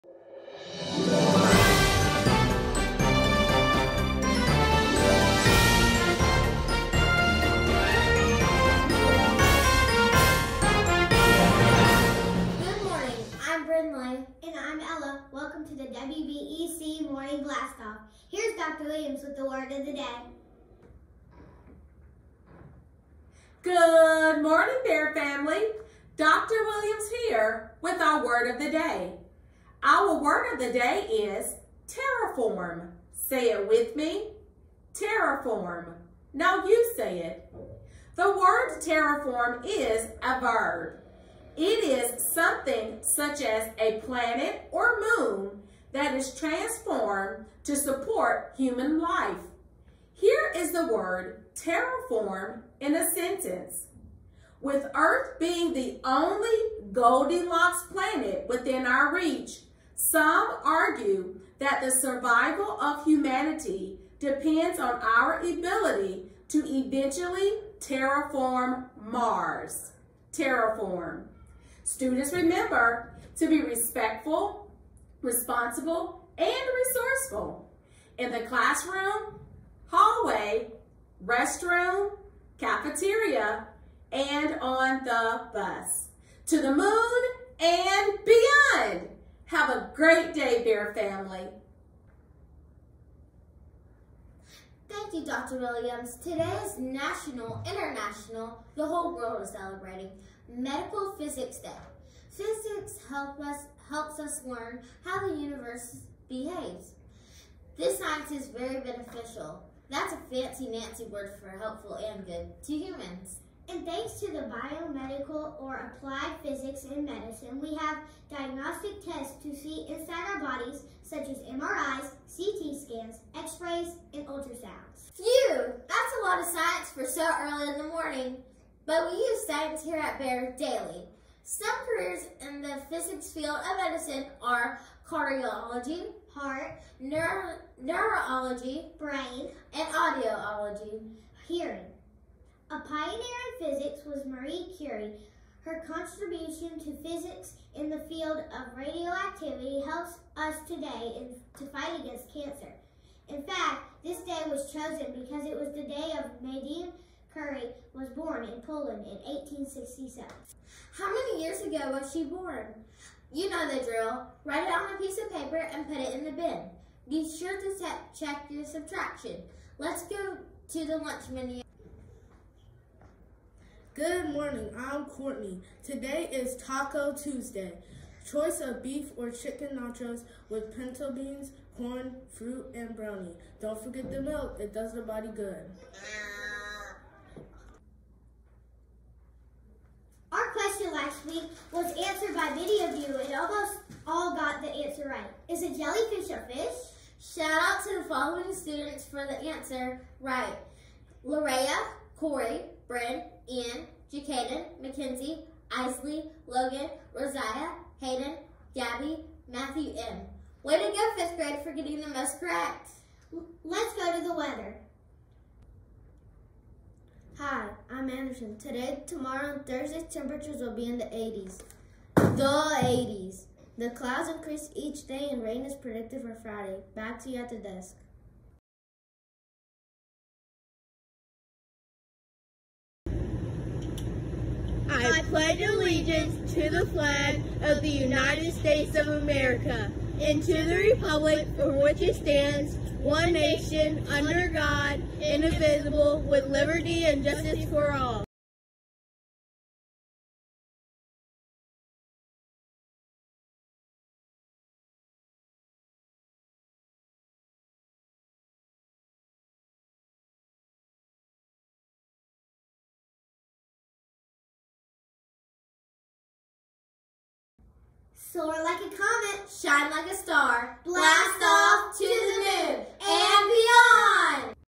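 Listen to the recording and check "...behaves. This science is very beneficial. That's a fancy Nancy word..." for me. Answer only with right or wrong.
right.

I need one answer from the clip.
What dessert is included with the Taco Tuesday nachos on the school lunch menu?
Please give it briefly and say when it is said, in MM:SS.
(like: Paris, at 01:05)
brownie, at 03:02.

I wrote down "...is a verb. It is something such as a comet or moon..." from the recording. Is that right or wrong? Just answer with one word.
wrong.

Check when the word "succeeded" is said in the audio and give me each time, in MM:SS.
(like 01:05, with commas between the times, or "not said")
not said.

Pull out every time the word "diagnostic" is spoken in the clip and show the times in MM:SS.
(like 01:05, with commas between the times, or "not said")
01:58.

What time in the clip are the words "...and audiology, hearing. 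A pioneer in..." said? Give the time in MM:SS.
02:19.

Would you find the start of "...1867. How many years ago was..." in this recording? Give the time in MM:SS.
02:39.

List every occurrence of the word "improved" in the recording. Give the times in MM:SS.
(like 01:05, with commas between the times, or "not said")
not said.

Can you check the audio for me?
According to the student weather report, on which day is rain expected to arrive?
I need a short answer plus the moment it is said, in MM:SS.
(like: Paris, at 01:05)
Friday, at 03:46.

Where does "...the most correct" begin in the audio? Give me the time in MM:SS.
03:32.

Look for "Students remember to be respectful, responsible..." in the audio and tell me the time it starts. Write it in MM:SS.
01:11.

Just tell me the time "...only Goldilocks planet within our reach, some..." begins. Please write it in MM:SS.
00:56.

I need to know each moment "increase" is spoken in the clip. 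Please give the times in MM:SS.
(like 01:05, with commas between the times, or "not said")
03:44.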